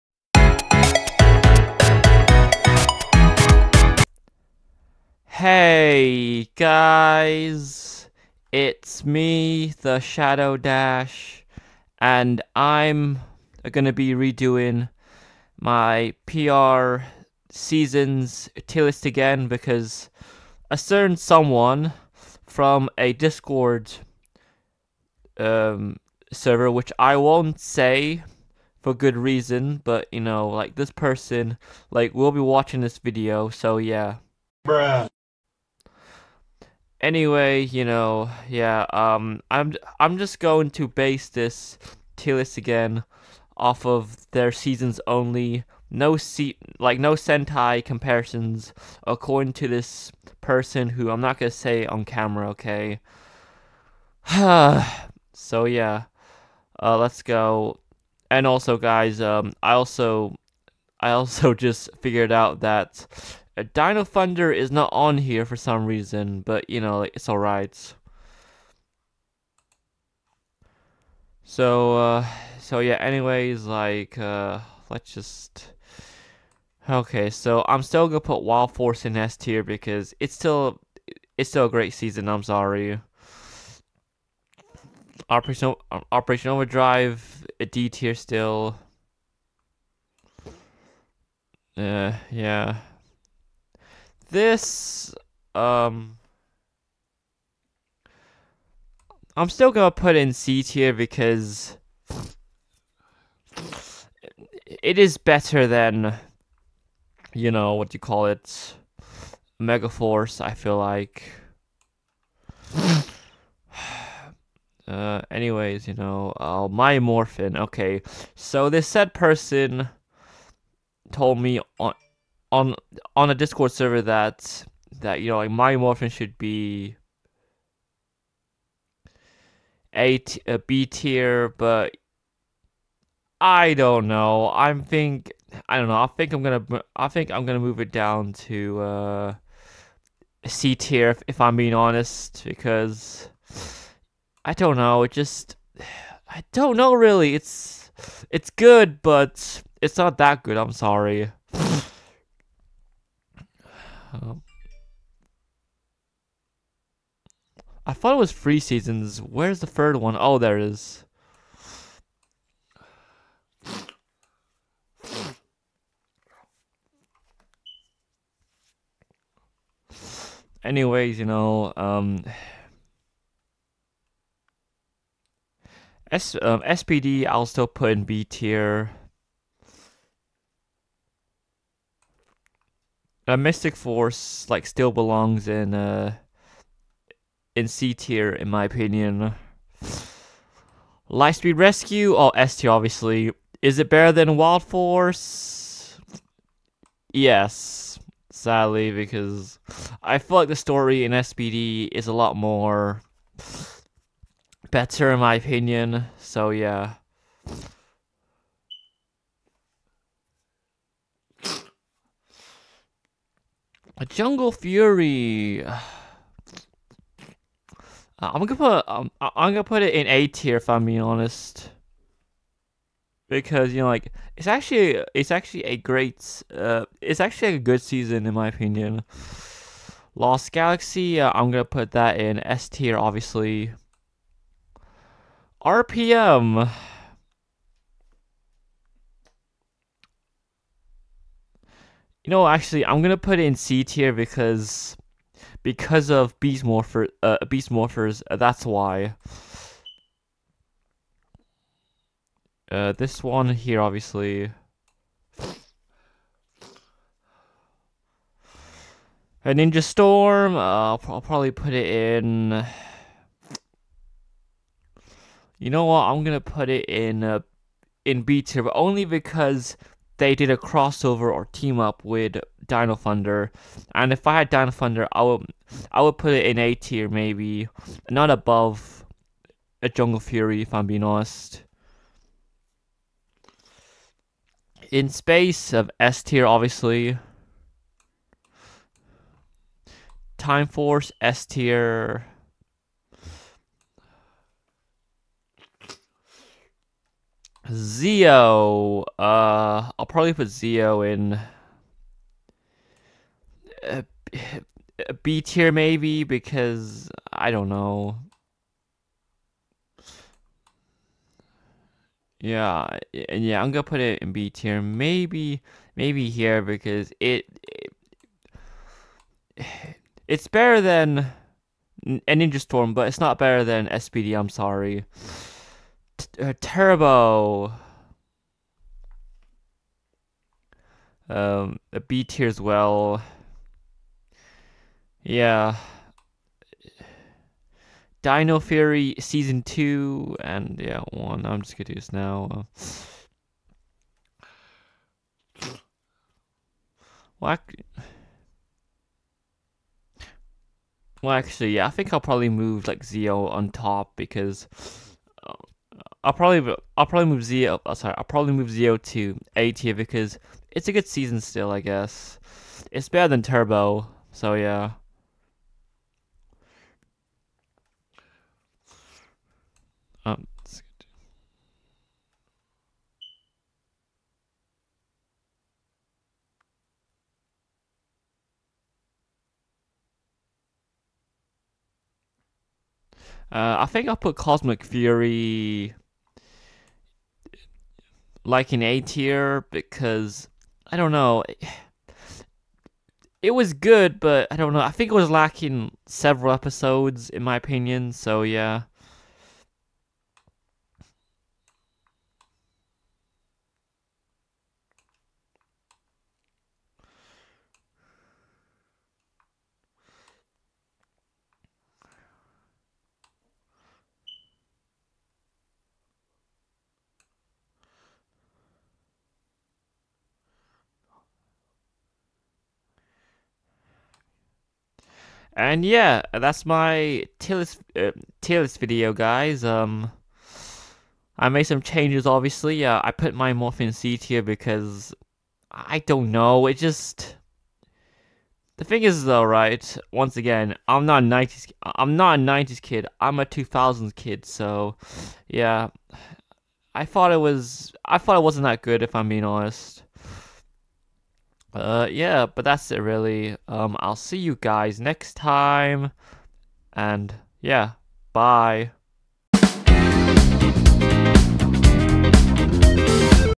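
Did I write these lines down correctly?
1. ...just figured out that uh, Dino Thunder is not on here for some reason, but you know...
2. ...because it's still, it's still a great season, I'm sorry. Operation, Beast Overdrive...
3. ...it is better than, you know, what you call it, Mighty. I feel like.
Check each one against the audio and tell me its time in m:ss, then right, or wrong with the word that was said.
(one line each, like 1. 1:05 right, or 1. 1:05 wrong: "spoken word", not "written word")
1. 1:01 right
2. 1:19 wrong: "Operation", not "Beast"
3. 1:44 wrong: "Megaforce", not "Mighty".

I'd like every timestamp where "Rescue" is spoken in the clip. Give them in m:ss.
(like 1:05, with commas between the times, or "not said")
3:11.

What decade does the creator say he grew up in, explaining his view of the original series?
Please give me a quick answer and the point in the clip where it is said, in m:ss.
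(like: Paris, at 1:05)
2000s, at 7:23.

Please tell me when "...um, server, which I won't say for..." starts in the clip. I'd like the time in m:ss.
0:25.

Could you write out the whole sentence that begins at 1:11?
So, uh, so yeah, anyways, like, uh, let's just...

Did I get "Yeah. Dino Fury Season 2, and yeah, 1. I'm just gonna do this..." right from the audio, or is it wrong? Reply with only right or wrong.
right.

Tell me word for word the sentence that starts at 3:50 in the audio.
Lost Galaxy, uh, I'm gonna put that in S tier obviously.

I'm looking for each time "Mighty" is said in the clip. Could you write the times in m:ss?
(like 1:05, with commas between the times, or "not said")
2:05.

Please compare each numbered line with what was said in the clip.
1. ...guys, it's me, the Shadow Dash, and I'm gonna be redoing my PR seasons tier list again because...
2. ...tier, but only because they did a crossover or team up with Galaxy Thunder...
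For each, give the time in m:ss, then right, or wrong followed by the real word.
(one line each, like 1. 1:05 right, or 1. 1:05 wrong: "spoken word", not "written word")
1. 0:06 right
2. 4:28 wrong: "Dino", not "Galaxy".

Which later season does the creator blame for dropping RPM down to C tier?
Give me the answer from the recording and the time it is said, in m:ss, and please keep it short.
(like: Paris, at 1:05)
Beast Morphers, at 4:07.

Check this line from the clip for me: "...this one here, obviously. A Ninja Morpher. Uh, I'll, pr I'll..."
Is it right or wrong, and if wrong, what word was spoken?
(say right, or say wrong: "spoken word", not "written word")
wrong: "Storm", not "Morpher".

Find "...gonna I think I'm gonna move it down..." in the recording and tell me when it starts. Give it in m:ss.
2:16.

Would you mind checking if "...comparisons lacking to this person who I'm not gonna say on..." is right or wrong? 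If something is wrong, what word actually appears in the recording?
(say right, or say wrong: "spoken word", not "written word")
wrong: "according", not "lacking".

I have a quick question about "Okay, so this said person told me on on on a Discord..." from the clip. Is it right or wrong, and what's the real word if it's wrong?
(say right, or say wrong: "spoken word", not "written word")
right.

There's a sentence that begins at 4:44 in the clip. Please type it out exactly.
In space of S tier, obviously.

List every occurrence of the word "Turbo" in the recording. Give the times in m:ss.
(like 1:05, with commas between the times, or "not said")
5:26, 6:03.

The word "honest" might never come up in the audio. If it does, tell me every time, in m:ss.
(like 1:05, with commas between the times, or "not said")
2:21, 3:41, 4:41, 7:29.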